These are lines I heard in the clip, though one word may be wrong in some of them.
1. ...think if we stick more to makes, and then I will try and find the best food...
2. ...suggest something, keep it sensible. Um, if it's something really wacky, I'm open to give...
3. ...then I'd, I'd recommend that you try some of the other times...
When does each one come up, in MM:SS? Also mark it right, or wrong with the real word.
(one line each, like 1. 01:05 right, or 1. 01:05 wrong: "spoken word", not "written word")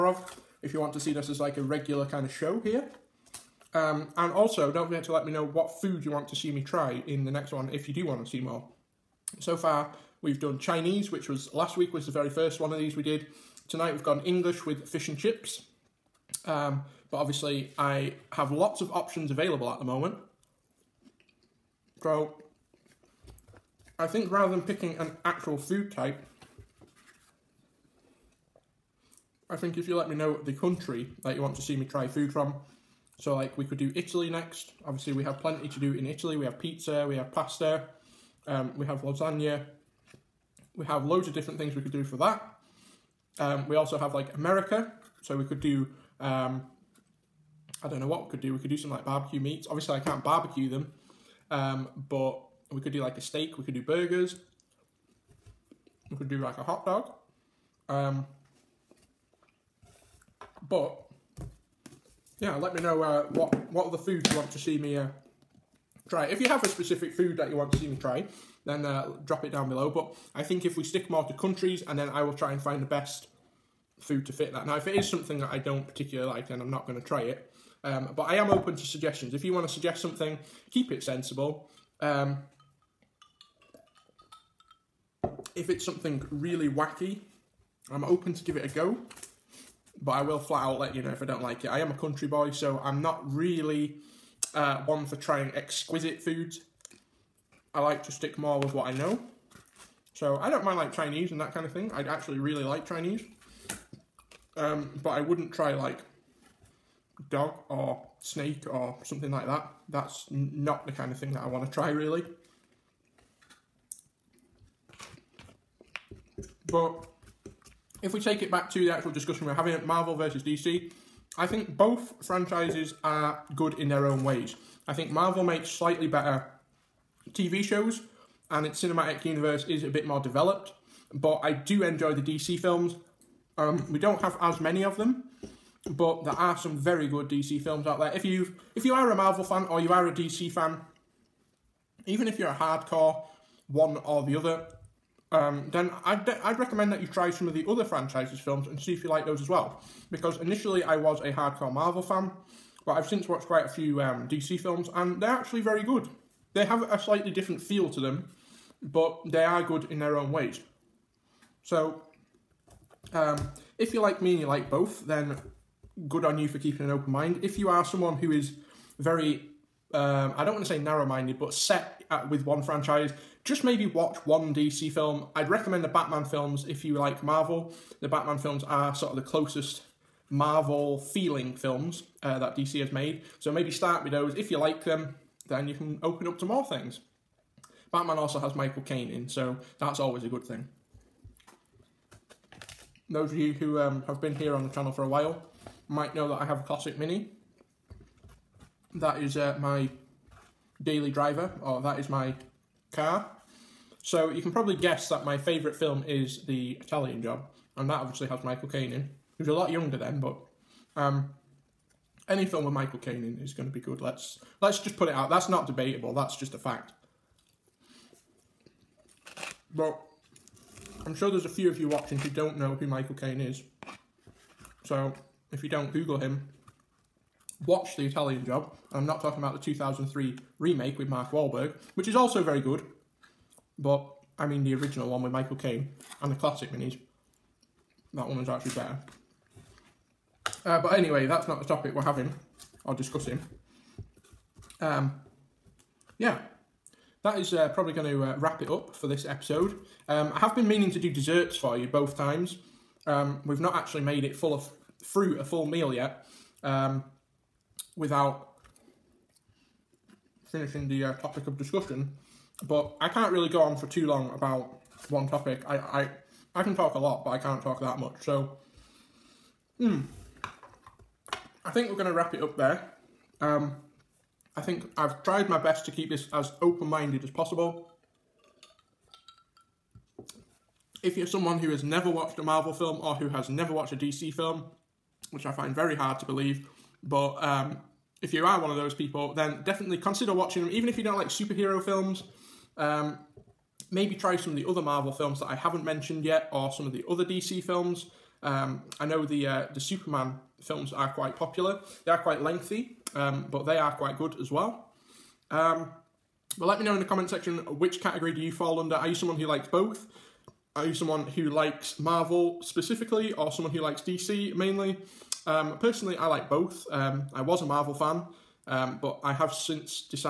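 1. 01:10 wrong: "countries", not "makes"
2. 01:19 right
3. 02:25 wrong: "franchises", not "times".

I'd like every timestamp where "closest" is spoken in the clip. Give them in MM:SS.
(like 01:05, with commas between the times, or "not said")
02:59.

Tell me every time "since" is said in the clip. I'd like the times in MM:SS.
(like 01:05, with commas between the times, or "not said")
02:33, 05:19.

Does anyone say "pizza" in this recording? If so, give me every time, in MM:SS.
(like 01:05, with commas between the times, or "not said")
00:36.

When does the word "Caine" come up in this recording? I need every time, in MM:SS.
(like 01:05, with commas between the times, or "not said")
03:08, 03:28, 03:32, 03:43, 03:55.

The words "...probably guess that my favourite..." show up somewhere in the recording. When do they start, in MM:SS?
03:24.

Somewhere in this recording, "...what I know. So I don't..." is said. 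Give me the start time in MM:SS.
01:38.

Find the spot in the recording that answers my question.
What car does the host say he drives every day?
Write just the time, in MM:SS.
03:16.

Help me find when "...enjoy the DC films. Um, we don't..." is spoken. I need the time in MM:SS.
02:11.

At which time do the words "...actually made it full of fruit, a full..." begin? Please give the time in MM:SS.
04:13.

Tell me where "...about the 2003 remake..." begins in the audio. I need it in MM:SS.
03:49.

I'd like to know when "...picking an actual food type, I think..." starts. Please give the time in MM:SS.
00:24.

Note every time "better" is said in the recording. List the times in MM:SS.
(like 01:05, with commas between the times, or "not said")
02:06, 03:58.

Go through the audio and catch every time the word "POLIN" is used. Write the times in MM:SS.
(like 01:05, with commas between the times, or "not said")
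not said.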